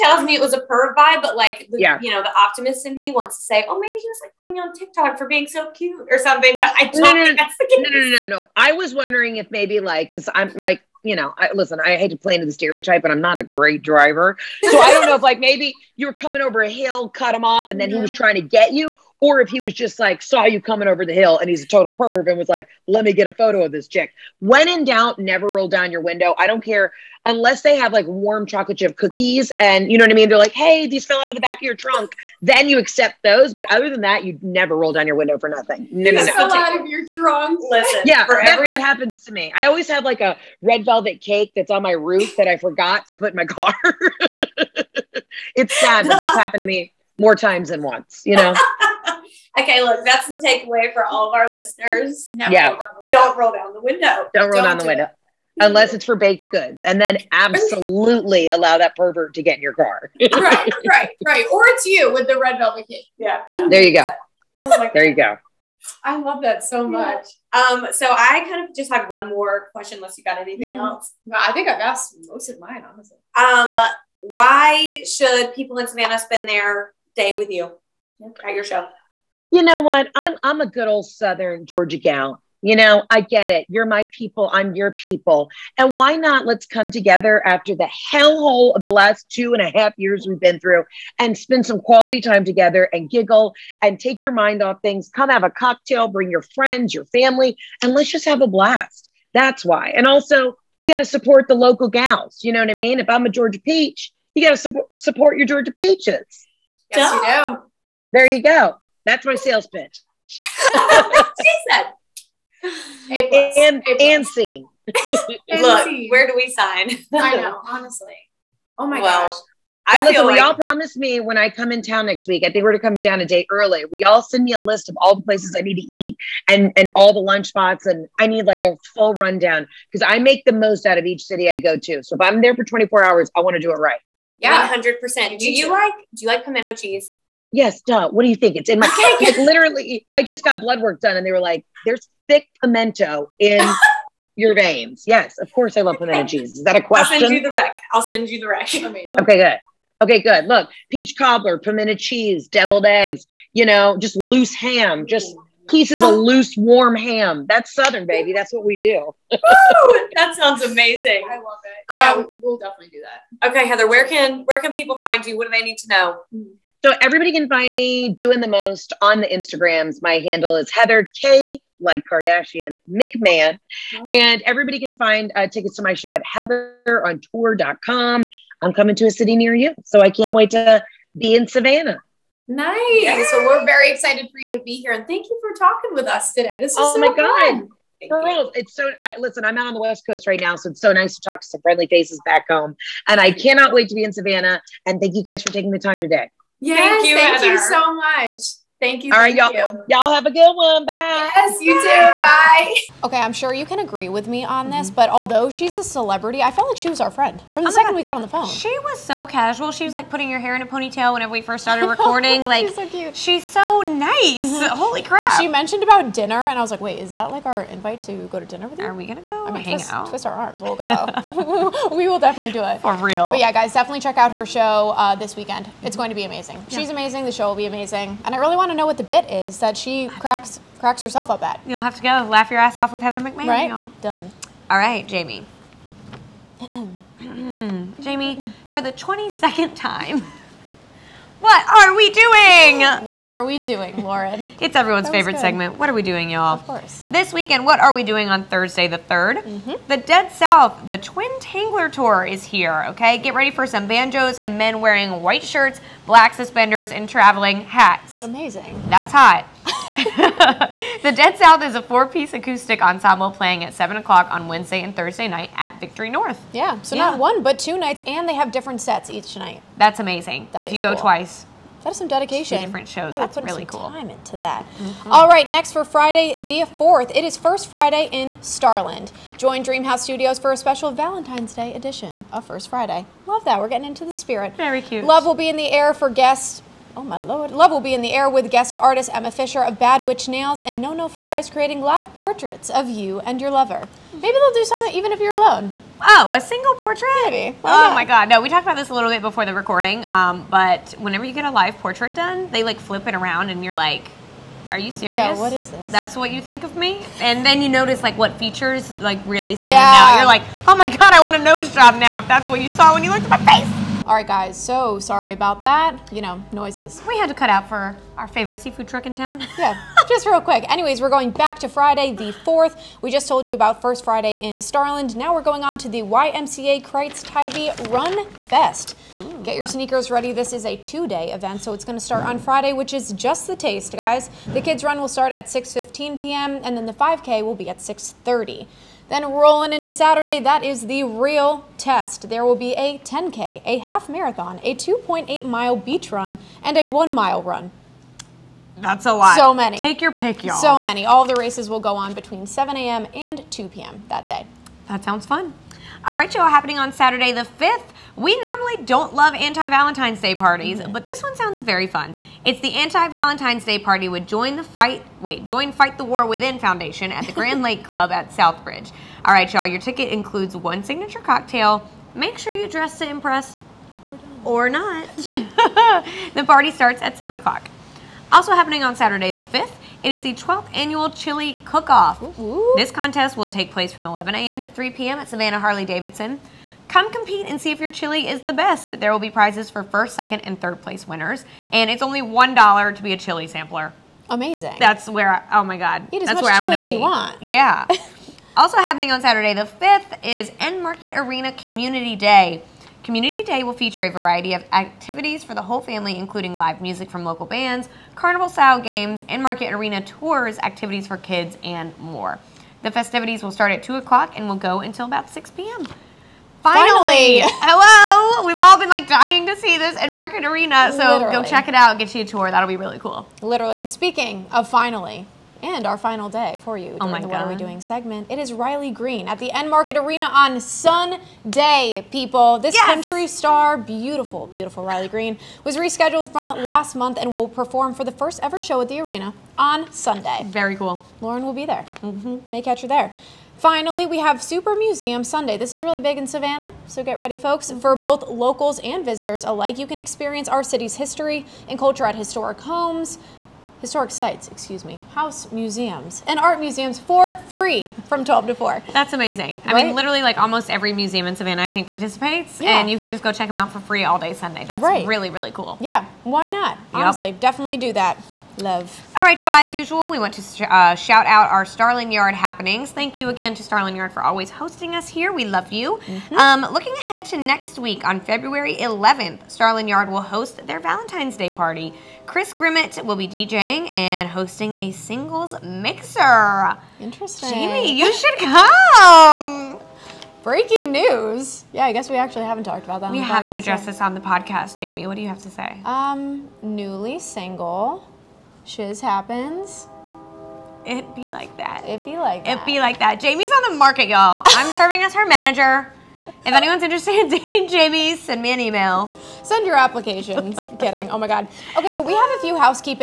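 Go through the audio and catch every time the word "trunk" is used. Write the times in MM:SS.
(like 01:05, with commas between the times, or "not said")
00:31, 00:37.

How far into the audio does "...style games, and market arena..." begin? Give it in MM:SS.
06:48.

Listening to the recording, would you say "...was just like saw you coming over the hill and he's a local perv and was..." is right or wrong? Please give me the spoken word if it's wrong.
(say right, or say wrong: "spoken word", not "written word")
wrong: "total", not "local".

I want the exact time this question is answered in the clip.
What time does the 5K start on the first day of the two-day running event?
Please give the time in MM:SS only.
05:37.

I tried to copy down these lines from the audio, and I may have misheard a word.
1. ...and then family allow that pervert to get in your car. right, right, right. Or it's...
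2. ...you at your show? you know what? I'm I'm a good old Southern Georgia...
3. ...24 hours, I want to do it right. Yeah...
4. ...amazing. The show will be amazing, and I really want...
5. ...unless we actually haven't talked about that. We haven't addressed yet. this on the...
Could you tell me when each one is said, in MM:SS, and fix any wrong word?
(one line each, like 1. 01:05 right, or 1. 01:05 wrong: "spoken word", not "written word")
1. 00:56 wrong: "absolutely", not "family"
2. 01:17 right
3. 02:12 right
4. 03:46 right
5. 08:11 wrong: "guess", not "unless".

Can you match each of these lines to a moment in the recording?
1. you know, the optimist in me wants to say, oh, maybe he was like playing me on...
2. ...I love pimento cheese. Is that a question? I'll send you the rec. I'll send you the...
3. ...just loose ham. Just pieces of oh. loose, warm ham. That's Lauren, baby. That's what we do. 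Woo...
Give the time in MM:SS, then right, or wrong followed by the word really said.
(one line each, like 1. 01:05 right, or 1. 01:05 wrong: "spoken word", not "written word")
1. 00:02 wrong: "putting", not "playing"
2. 02:25 right
3. 02:33 wrong: "Southern", not "Lauren".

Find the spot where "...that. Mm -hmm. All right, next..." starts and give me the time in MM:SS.
04:34.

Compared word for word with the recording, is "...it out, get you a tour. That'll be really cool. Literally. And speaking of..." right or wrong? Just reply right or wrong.
right.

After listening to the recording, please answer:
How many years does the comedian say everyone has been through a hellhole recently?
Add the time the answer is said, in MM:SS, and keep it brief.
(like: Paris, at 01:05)
2.5, at 01:29.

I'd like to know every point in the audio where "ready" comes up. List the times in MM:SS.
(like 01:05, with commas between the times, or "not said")
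04:13, 05:30, 07:27.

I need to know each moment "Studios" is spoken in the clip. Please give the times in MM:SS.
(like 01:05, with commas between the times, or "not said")
04:40.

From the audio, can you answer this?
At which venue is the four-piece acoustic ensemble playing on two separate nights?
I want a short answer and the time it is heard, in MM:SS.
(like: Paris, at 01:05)
Victory North, at 04:25.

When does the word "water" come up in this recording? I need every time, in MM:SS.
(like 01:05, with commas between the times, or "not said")
not said.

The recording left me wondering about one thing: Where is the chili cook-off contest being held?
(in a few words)
Savannah Harley-Davidson.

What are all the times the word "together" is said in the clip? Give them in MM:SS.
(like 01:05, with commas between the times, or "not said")
01:26, 01:32.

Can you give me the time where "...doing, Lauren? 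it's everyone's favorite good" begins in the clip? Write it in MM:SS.
04:03.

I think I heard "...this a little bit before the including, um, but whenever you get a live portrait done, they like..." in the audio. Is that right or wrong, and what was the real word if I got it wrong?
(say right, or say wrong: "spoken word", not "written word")
wrong: "recording", not "including".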